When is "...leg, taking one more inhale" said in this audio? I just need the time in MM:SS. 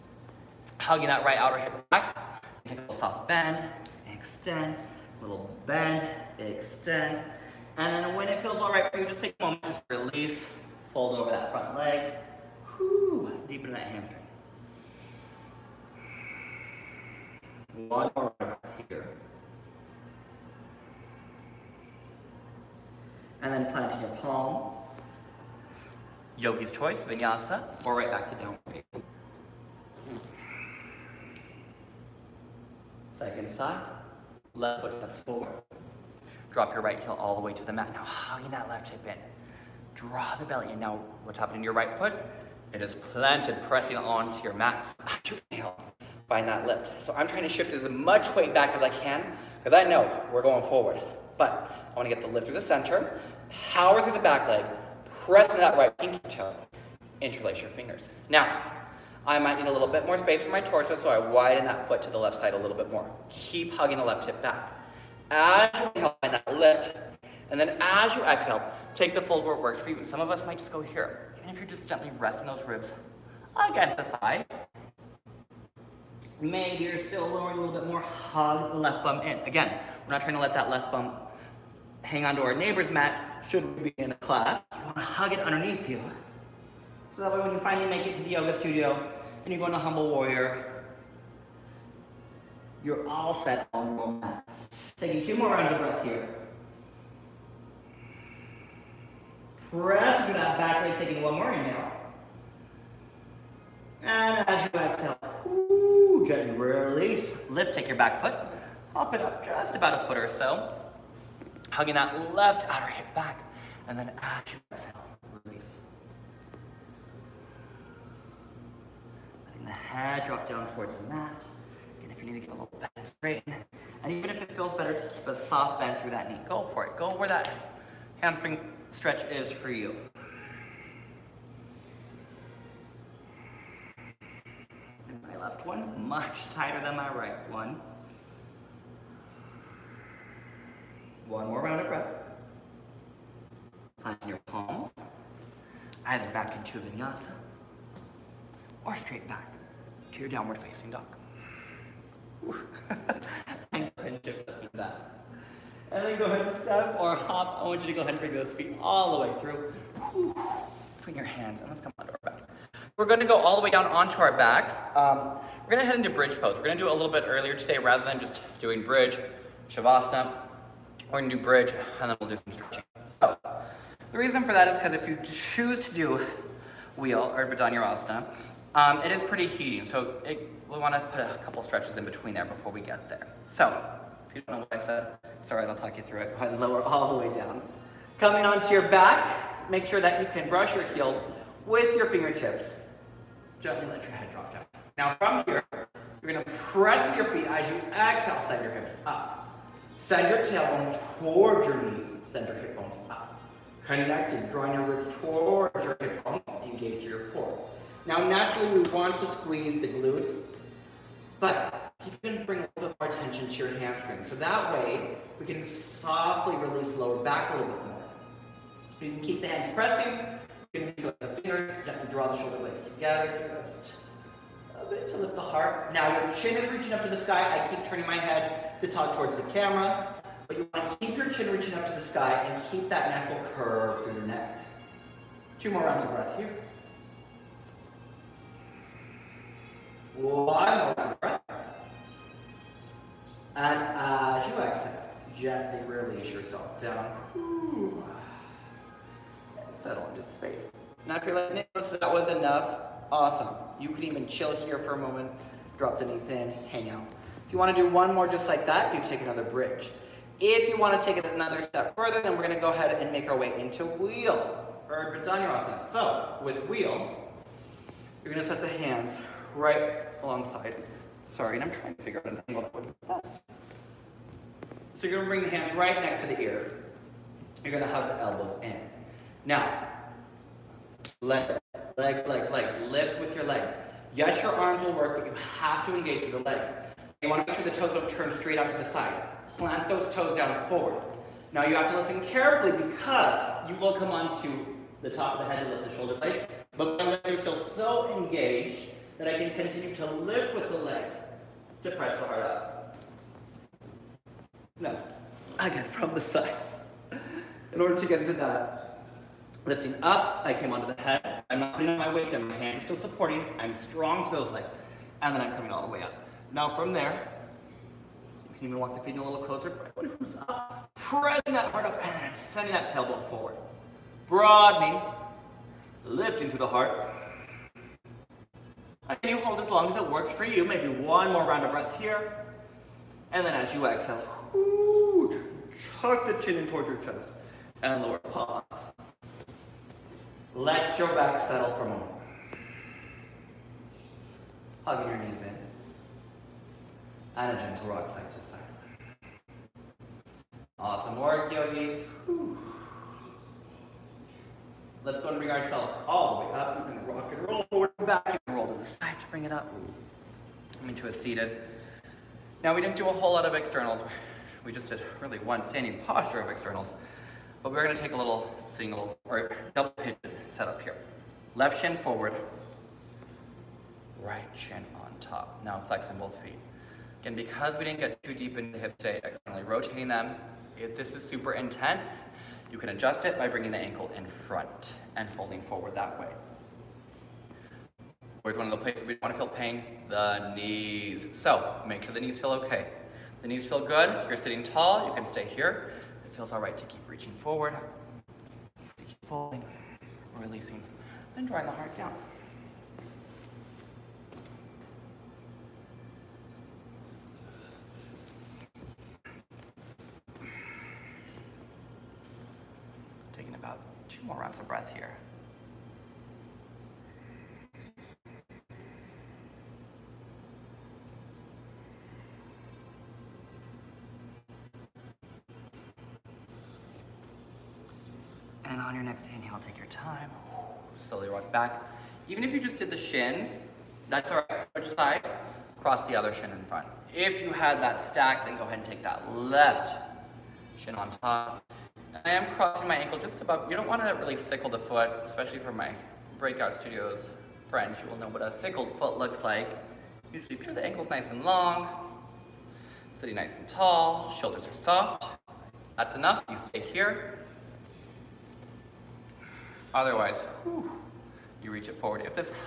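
01:40.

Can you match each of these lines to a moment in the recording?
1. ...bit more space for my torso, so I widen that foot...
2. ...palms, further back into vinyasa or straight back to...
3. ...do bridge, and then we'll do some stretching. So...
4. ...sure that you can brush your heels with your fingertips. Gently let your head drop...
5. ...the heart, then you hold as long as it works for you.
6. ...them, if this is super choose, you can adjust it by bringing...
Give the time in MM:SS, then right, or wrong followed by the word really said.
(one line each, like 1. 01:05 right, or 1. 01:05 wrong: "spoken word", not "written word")
1. 00:59 right
2. 02:24 wrong: "either", not "further"
3. 02:51 right
4. 03:09 right
5. 05:26 right
6. 06:20 wrong: "intense", not "choose".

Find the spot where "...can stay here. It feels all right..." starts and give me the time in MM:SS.
06:35.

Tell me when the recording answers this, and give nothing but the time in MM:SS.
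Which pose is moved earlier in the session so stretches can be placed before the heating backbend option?
02:46.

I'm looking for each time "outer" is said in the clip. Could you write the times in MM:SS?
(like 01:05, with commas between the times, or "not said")
00:01, 01:52.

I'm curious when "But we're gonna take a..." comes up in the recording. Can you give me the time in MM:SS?
06:07.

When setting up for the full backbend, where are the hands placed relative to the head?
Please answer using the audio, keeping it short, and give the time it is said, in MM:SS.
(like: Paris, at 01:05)
Next to the ears, at 04:35.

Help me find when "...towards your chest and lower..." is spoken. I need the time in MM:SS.
05:36.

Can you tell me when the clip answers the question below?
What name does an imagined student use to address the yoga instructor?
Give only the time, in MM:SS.
04:11.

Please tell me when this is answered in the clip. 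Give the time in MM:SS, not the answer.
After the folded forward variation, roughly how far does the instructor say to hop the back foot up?
01:49.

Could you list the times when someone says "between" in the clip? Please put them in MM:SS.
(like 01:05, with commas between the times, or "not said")
02:40, 03:02.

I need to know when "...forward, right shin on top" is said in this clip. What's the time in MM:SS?
06:11.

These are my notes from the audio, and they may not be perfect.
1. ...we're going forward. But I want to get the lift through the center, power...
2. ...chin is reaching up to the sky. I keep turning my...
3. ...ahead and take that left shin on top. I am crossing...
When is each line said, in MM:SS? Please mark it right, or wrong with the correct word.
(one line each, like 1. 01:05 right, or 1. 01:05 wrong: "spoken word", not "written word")
1. 00:50 right
2. 03:46 right
3. 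07:18 right.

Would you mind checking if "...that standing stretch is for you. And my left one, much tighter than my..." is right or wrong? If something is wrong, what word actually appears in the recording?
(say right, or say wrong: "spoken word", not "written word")
wrong: "hamstring", not "standing".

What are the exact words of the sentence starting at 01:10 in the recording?
Some of us might just go here.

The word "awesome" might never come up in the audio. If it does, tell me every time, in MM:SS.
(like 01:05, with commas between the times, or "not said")
04:13, 05:50.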